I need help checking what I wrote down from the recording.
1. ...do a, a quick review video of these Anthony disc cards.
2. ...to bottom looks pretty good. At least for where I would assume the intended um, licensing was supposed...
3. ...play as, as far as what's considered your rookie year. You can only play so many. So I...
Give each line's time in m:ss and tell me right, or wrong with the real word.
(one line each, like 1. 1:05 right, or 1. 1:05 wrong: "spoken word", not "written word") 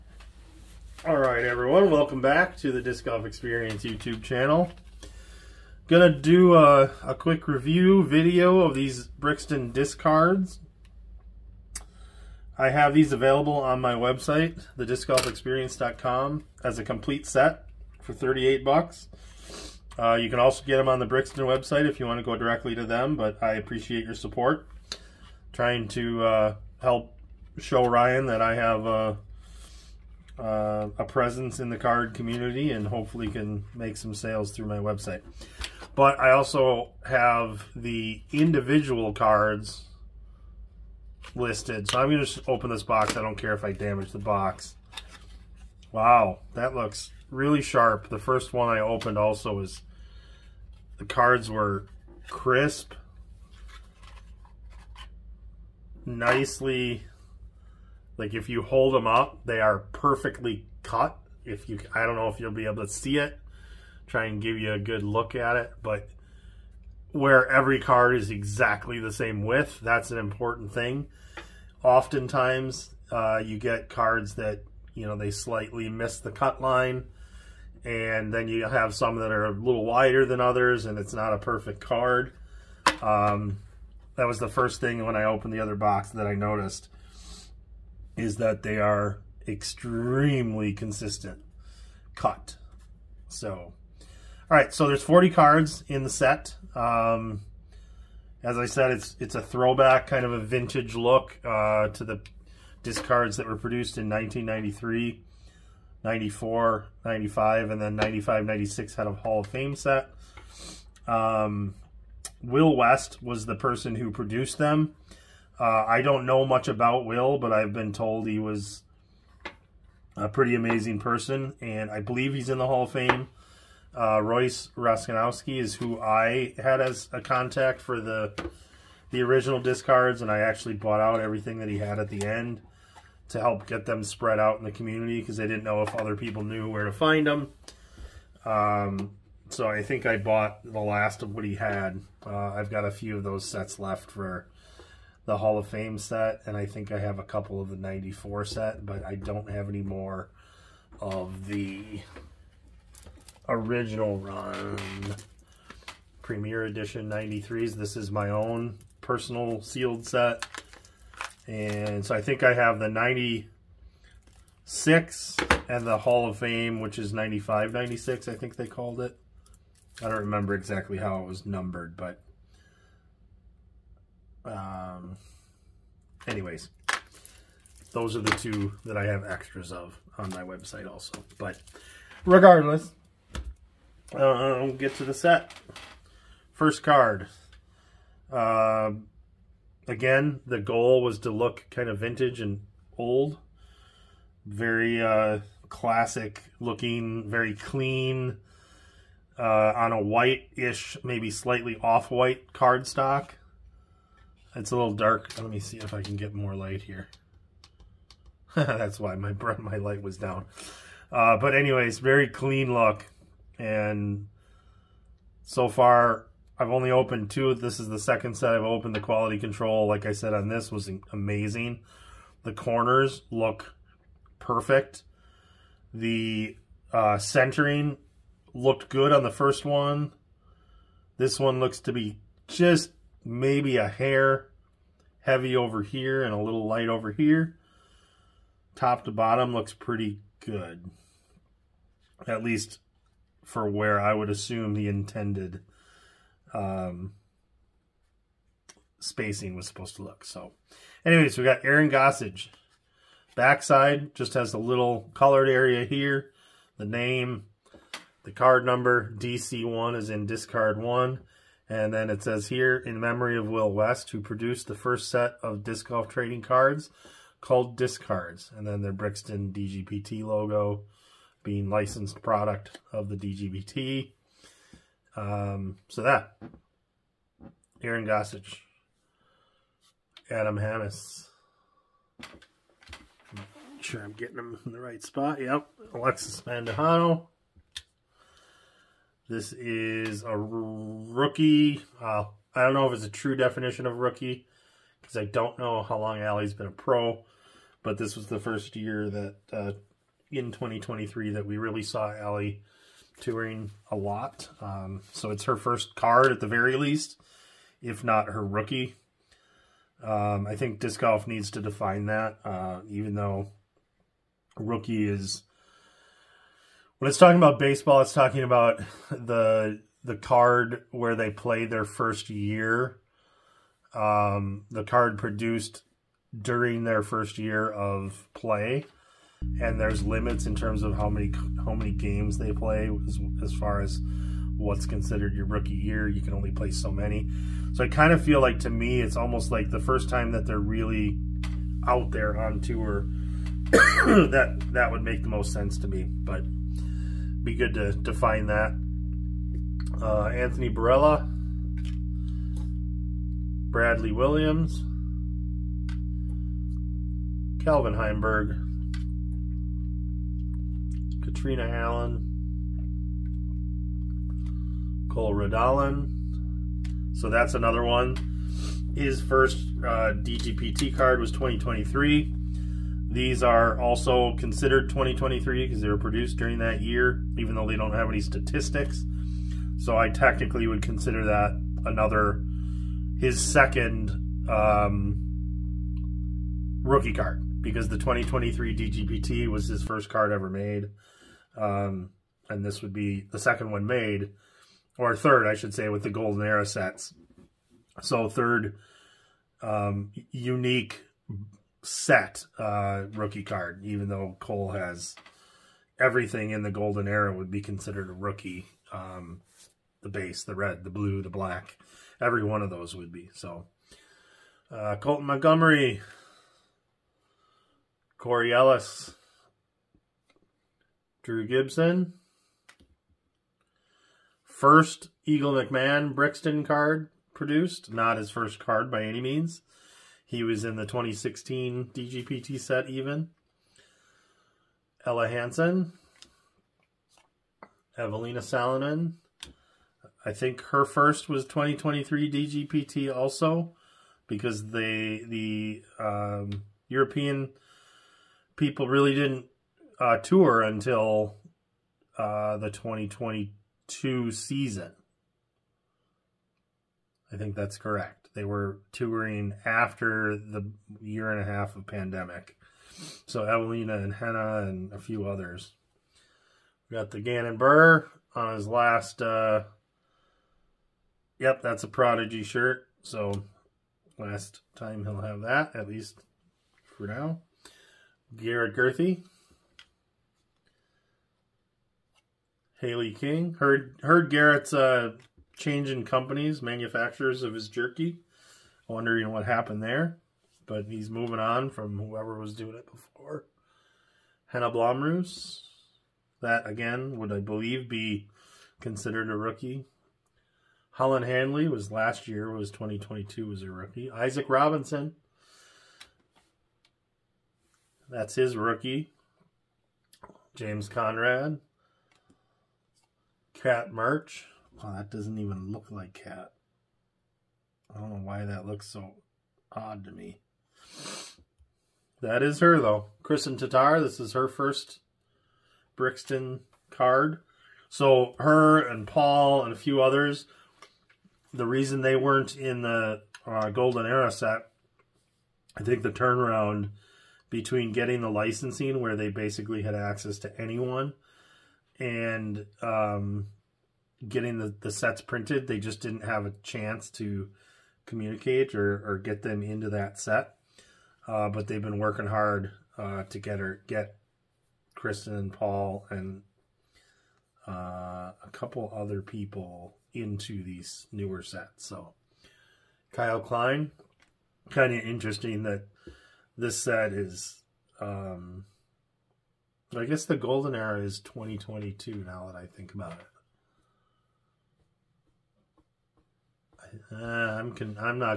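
1. 0:06 wrong: "Brixton", not "Anthony"
2. 3:59 wrong: "spacing", not "licensing"
3. 5:32 right.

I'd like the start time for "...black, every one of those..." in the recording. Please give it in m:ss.
6:51.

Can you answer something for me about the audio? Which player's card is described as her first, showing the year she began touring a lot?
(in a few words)
Alexis Mandujano.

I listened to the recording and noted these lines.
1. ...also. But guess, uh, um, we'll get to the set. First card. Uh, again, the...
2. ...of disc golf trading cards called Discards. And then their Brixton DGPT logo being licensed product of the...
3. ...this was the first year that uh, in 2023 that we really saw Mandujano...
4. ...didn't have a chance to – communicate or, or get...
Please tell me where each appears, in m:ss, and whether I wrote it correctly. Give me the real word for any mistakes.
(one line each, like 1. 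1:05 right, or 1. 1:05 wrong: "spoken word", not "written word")
1. 3:00 wrong: "regardless", not "guess"
2. 4:25 right
3. 4:57 wrong: "Allie", not "Mandujano"
4. 9:06 right.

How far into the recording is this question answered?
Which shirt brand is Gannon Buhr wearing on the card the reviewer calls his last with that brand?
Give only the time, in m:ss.
7:51.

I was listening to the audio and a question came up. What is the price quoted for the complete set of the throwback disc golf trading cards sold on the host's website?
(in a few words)
$38.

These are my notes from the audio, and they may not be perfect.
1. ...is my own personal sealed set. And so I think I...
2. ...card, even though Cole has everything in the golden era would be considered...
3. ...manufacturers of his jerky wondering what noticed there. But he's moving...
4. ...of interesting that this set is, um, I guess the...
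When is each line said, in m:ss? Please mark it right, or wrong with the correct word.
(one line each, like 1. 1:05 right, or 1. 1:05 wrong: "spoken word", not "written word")
1. 2:37 right
2. 6:43 right
3. 8:06 wrong: "happened", not "noticed"
4. 9:24 right.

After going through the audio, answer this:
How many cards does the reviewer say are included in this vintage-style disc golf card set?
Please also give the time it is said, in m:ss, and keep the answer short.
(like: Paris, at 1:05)
40, at 1:35.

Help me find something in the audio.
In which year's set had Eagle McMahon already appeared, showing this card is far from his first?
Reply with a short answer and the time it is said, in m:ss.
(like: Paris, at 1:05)
2016, at 7:10.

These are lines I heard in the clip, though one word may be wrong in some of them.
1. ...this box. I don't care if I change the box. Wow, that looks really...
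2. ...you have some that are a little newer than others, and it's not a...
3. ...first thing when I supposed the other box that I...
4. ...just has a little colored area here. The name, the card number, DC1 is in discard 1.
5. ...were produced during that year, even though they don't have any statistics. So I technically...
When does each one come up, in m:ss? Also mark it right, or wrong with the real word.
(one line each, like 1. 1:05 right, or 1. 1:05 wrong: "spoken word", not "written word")
1. 0:42 wrong: "damage", not "change"
2. 1:18 wrong: "wider", not "newer"
3. 1:24 wrong: "opened", not "supposed"
4. 4:14 right
5. 6:15 right.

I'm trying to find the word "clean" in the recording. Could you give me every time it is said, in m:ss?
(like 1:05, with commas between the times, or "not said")
3:17, 3:32.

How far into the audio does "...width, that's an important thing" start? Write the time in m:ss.
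1:09.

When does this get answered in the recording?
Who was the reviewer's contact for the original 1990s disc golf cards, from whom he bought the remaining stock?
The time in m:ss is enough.
2:04.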